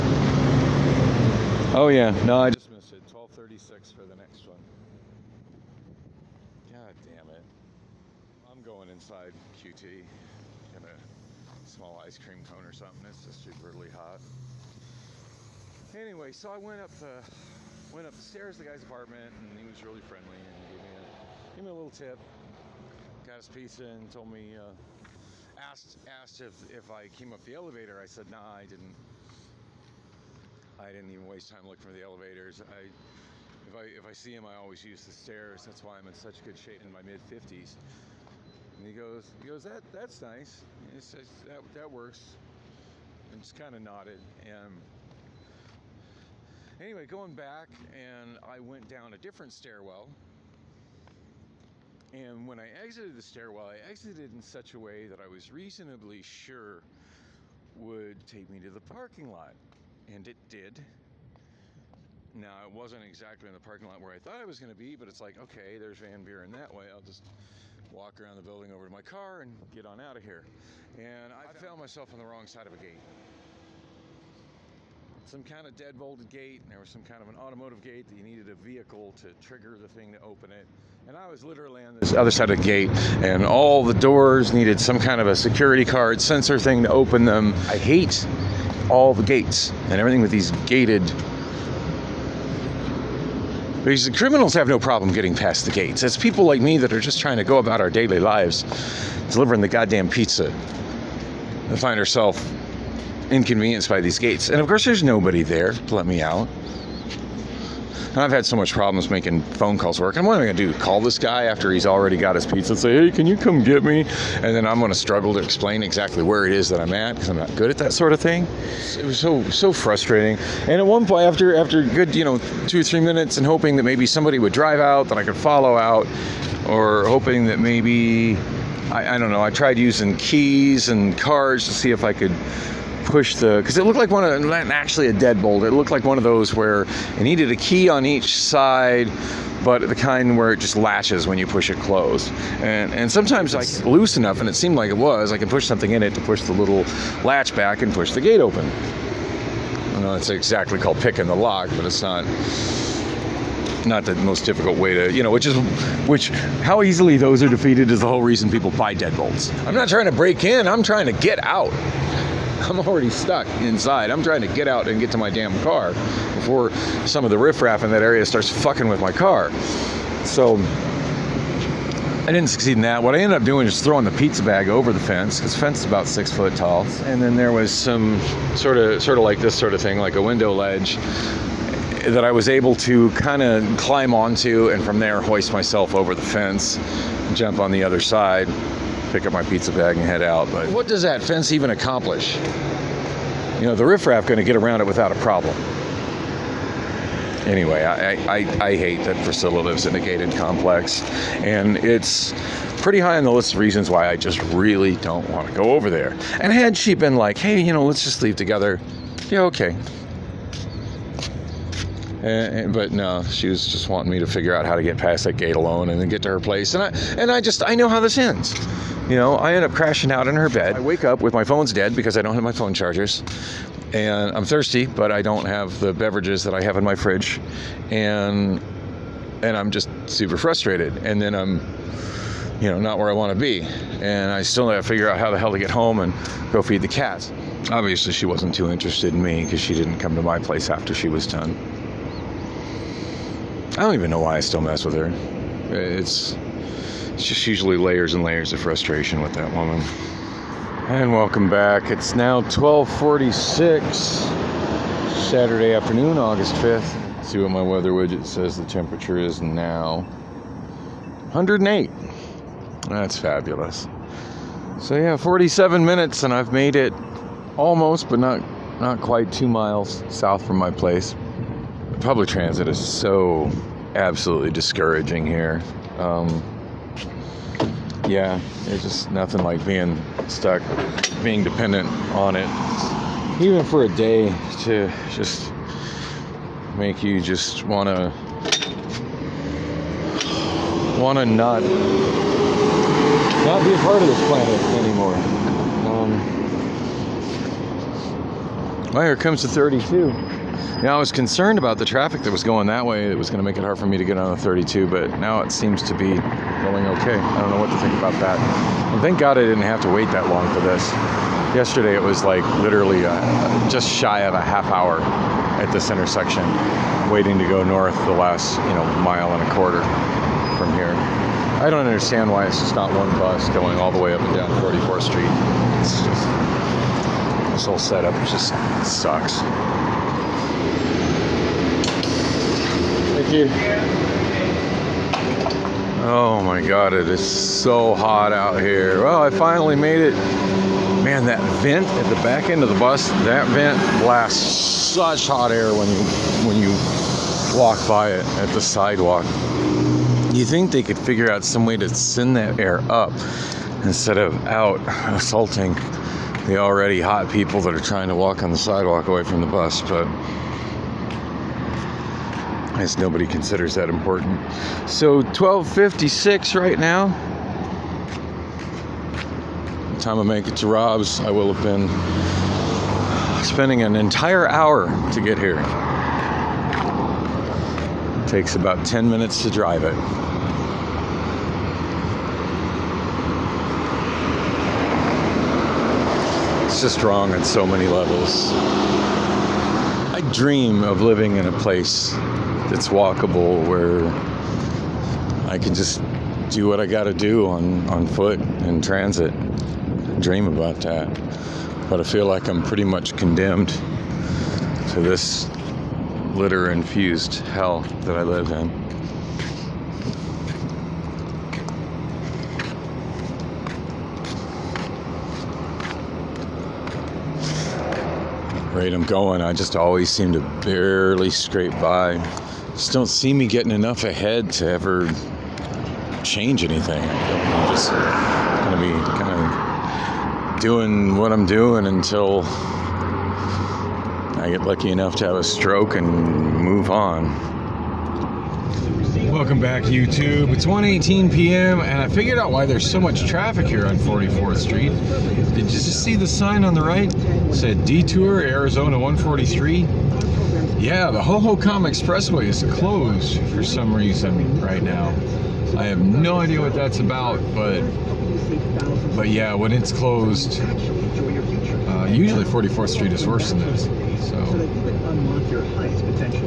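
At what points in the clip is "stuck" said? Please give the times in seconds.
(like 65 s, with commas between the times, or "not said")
163 s, 280 s.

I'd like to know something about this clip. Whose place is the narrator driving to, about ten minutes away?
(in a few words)
Rob's.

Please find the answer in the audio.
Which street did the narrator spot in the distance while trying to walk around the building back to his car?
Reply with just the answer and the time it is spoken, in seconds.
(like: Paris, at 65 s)
Van Buren, at 65 s.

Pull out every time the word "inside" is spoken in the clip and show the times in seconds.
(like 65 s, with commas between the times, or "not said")
8 s, 163 s.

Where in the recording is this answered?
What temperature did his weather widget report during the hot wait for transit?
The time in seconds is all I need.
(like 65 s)
261 s.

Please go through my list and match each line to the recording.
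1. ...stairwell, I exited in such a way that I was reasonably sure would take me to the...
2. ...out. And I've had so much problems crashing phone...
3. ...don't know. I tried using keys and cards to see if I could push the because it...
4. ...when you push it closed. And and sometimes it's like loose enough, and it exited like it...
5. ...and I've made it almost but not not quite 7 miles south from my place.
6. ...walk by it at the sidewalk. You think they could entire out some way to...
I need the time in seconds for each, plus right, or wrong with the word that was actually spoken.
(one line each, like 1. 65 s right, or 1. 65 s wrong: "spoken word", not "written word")
1. 53 s right
2. 106 s wrong: "making", not "crashing"
3. 129 s right
4. 141 s wrong: "seemed", not "exited"
5. 266 s wrong: "2", not "7"
6. 347 s wrong: "figure", not "entire".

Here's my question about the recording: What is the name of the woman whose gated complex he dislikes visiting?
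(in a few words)
Priscilla.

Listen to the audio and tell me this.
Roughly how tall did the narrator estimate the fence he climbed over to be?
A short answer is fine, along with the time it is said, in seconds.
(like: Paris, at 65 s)
6 feet, at 176 s.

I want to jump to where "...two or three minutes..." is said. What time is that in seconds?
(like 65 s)
122 s.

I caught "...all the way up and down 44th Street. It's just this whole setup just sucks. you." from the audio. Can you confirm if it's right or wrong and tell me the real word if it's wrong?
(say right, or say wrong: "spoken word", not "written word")
right.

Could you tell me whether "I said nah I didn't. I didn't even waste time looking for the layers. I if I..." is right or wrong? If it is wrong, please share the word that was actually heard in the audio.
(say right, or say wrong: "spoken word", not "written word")
wrong: "elevators", not "layers".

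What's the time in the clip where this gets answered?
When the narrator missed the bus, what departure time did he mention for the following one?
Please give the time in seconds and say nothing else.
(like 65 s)
3 s.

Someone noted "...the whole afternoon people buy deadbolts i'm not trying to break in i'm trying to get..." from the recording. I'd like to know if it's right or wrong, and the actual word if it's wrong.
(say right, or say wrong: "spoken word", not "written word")
wrong: "reason", not "afternoon".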